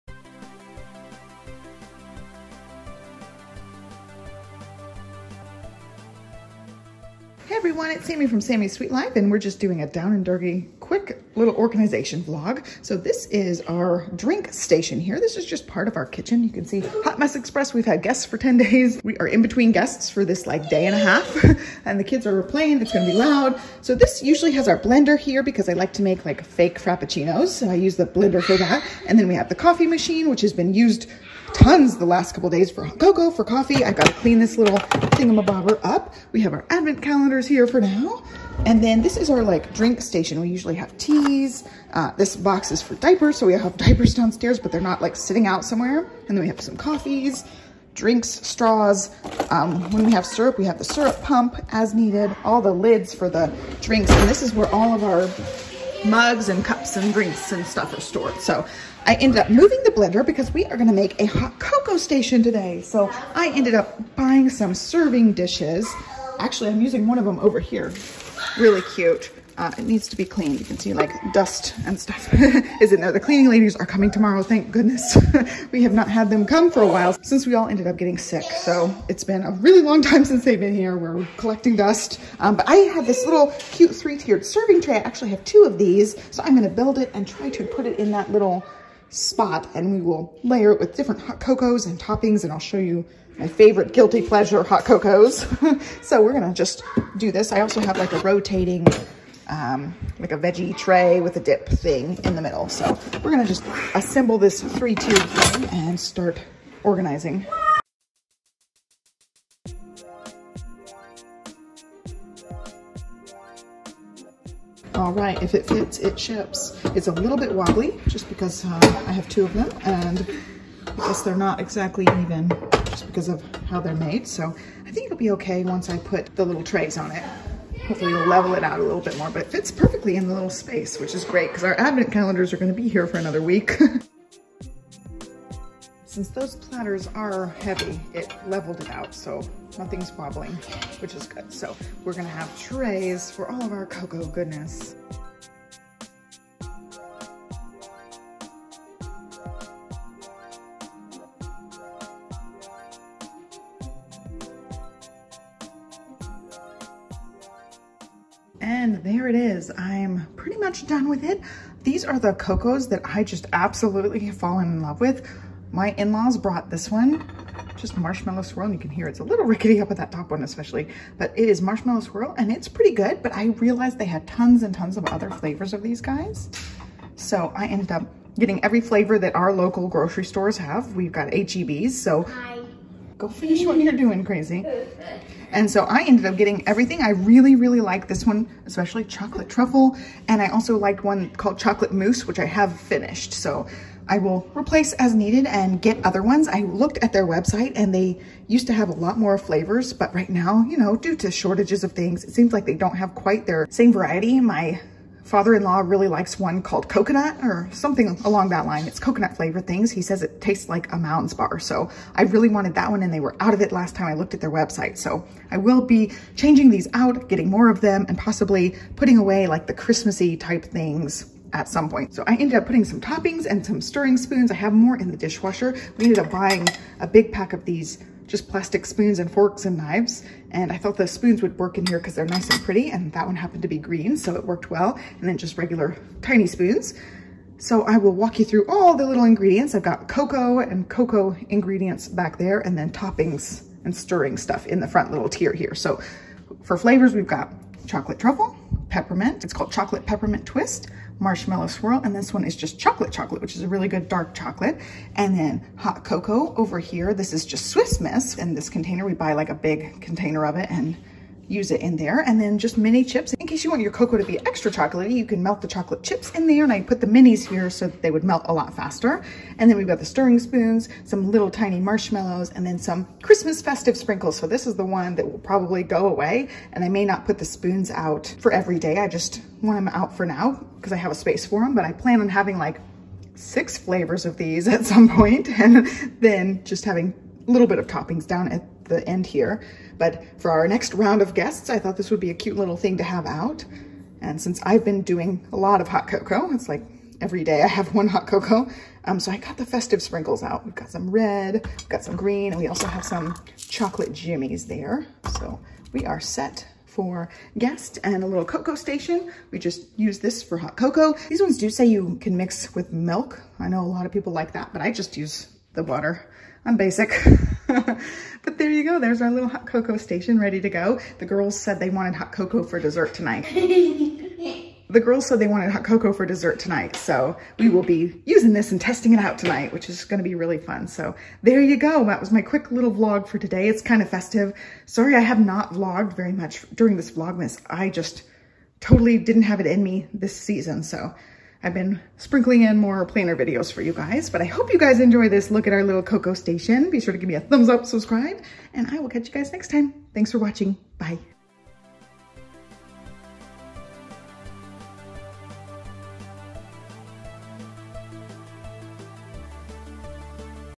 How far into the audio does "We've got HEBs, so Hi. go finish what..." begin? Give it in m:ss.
3:00.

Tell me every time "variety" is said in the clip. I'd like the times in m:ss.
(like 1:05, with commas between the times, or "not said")
3:23.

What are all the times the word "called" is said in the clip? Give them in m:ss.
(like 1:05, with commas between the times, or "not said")
3:11, 3:26, 4:09.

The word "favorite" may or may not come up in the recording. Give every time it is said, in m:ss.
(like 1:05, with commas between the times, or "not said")
1:33.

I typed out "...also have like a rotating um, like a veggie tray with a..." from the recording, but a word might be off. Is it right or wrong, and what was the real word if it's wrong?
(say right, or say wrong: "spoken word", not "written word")
right.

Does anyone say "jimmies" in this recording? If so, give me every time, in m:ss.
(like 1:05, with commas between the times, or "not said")
5:04.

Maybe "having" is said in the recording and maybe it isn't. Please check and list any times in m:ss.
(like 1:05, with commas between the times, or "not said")
4:42, 4:46.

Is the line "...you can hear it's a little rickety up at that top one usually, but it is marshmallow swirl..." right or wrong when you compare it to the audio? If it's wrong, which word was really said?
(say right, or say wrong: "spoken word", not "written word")
wrong: "especially", not "usually".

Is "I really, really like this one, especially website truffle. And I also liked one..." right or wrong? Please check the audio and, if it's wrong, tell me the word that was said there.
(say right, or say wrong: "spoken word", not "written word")
wrong: "chocolate", not "website".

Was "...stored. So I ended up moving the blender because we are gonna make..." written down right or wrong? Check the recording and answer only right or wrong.
right.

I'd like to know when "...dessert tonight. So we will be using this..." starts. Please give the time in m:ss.
5:26.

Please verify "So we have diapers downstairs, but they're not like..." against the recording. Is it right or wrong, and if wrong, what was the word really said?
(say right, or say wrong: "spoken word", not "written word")
right.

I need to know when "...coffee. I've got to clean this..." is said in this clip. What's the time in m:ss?
0:33.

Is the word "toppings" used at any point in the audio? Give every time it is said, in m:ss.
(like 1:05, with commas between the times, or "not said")
1:31, 3:43, 4:02, 4:47.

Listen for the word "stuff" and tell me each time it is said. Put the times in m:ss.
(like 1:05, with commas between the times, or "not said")
0:57, 1:11, 4:04.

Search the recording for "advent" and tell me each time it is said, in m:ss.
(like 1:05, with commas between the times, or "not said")
0:36, 2:11.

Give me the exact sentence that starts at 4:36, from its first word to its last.
And I may not put the spoons out for every day.